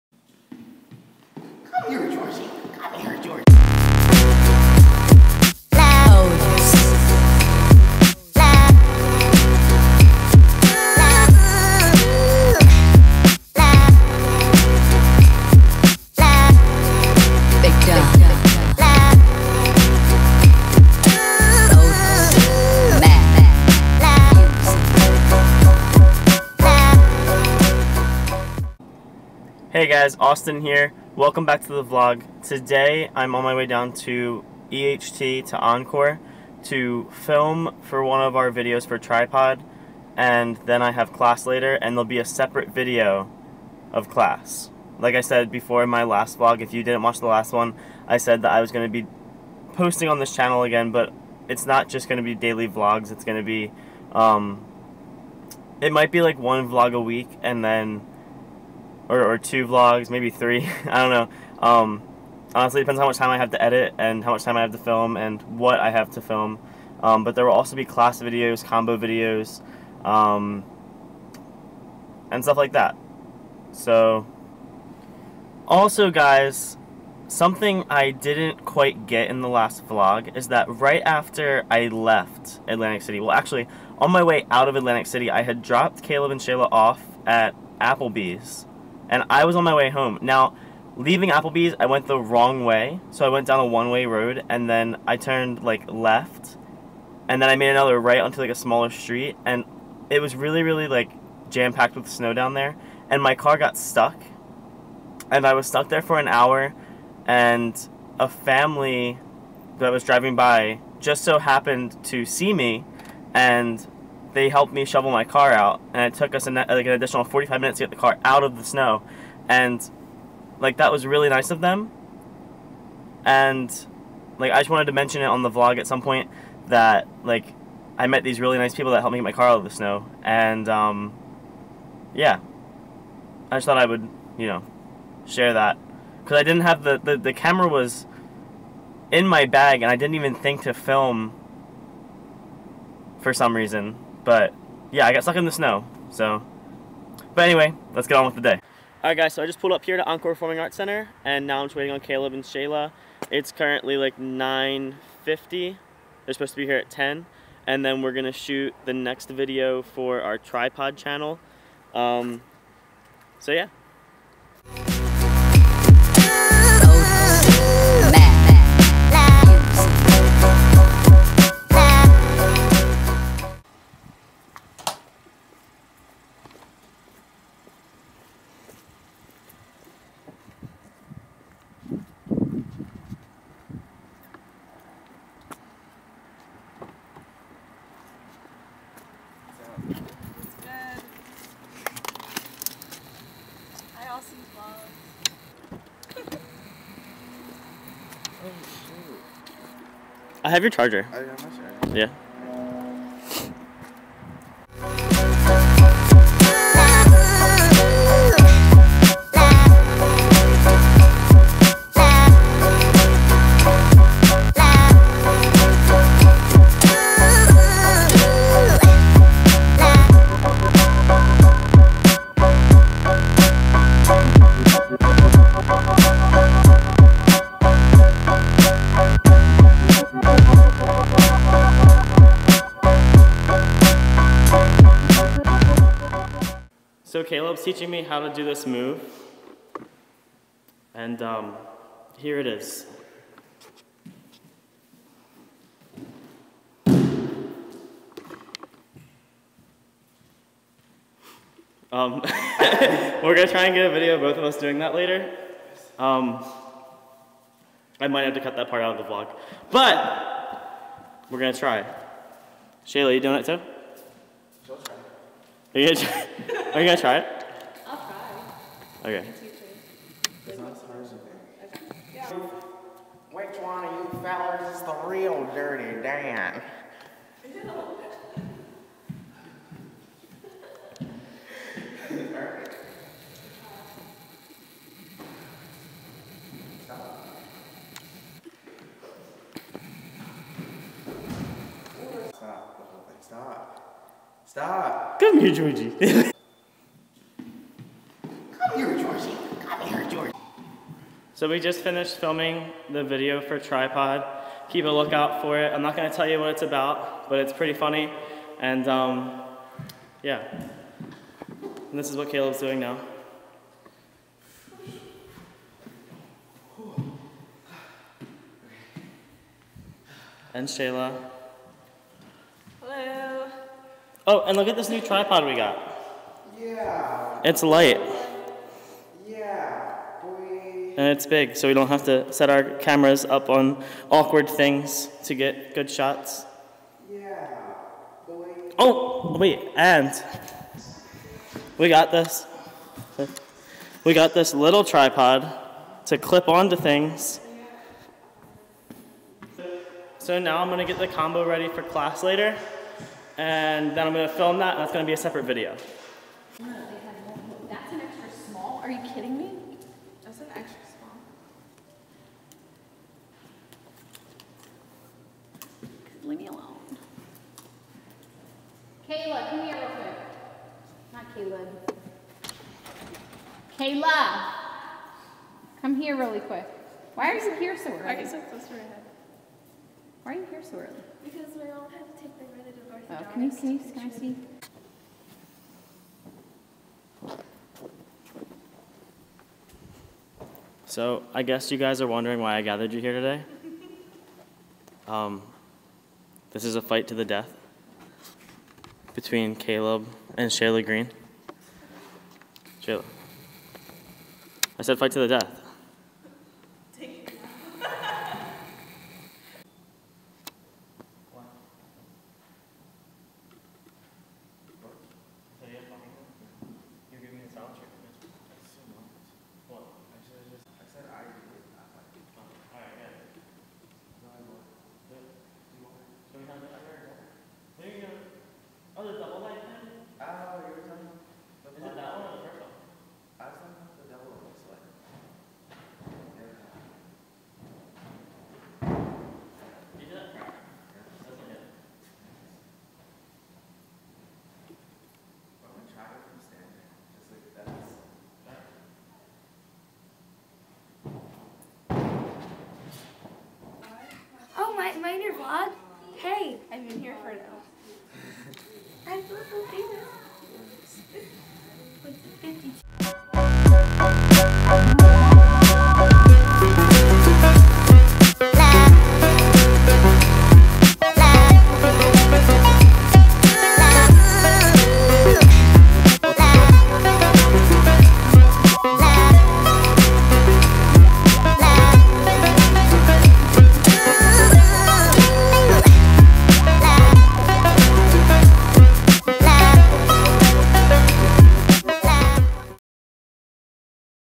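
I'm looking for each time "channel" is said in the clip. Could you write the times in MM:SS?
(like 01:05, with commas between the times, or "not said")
00:50, 02:40.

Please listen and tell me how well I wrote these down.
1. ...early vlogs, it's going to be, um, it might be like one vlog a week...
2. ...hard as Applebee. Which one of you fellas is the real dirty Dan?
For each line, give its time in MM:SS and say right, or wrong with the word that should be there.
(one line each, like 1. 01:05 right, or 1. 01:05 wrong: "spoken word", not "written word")
1. 00:52 wrong: "daily", not "early"
2. 04:30 wrong: "Okay", not "Applebee".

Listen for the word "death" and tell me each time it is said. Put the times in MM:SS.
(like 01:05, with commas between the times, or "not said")
06:37, 06:45.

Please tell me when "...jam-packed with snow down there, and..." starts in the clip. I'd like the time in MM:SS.
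01:41.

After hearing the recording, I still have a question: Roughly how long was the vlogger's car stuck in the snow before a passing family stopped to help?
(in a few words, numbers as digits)
An hour.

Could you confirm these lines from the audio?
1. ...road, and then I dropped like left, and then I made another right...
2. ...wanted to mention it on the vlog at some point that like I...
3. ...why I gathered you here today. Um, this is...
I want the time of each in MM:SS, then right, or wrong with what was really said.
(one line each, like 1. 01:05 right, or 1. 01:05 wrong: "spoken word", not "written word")
1. 01:34 wrong: "turned", not "dropped"
2. 02:04 right
3. 06:32 right.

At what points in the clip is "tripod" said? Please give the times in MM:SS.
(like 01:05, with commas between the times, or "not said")
00:38, 02:40, 05:03, 05:25, 05:44.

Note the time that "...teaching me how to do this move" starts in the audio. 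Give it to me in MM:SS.
03:57.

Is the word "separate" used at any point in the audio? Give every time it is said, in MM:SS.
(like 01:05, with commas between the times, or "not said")
00:42, 05:55.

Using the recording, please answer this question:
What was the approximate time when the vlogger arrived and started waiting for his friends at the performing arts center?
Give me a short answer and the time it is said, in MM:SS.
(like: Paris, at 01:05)
9:50, at 02:34.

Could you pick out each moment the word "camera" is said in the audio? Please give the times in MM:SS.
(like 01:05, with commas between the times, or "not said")
02:17, 05:32.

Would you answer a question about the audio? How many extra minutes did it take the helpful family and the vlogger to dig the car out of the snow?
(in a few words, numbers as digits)
45 minutes.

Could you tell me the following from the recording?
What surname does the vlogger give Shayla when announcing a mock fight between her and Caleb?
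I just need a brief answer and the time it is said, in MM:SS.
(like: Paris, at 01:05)
Green, at 06:40.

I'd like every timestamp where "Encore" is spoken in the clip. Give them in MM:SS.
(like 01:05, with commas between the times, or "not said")
00:35, 02:30.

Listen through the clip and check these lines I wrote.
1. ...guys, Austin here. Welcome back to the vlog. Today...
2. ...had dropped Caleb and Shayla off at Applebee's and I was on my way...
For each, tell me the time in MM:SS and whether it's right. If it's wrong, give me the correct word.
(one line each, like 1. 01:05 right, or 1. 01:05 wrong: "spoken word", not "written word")
1. 00:29 right
2. 01:25 right.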